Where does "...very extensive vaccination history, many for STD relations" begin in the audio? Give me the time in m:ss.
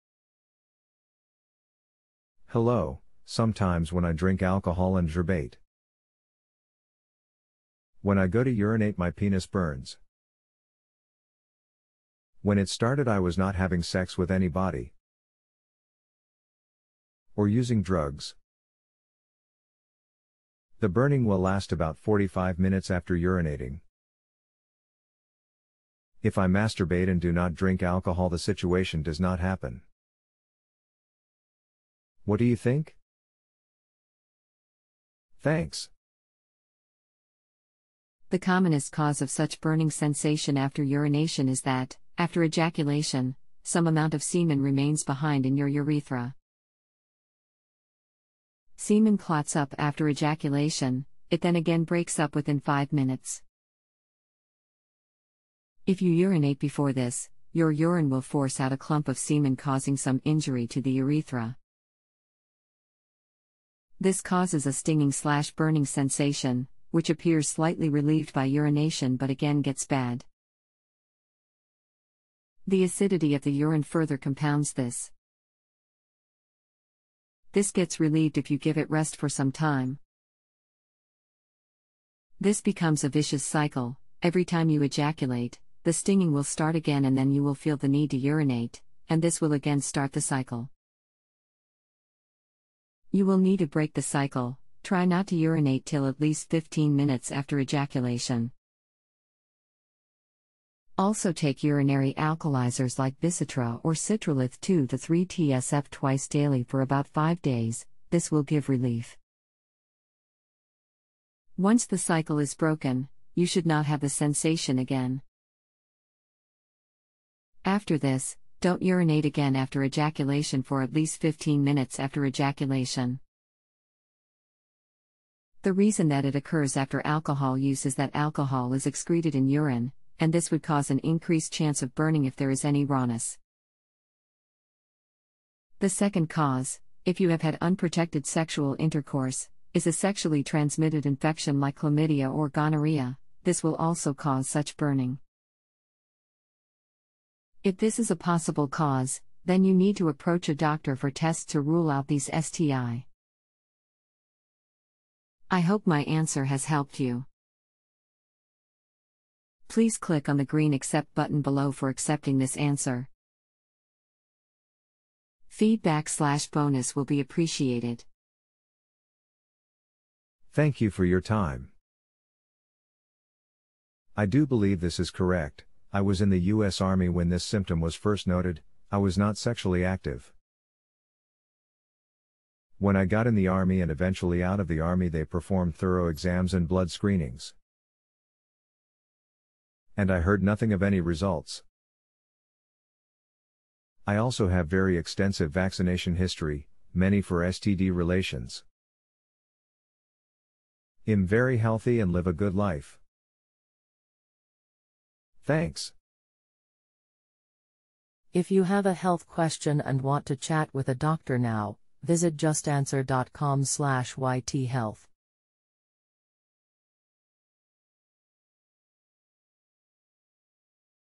3:14.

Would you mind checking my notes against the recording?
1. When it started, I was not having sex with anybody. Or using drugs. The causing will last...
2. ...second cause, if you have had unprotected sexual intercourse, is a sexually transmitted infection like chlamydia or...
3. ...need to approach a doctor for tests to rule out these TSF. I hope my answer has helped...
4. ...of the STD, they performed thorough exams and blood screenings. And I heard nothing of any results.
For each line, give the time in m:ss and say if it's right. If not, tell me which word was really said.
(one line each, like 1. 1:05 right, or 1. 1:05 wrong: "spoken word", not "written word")
1. 0:12 wrong: "burning", not "causing"
2. 2:15 right
3. 2:29 wrong: "STI", not "TSF"
4. 3:04 wrong: "Army", not "STD".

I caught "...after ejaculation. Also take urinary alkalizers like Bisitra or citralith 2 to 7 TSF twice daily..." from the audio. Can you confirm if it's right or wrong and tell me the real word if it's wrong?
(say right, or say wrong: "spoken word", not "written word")
wrong: "3", not "7".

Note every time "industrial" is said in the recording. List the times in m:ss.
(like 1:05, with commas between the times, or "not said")
not said.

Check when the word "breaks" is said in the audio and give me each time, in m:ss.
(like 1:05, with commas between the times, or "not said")
0:51, 1:33.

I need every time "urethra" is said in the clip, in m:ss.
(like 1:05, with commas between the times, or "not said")
0:45, 1:00.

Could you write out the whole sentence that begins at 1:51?
Once the cycle is broken, you should not have the sensation again.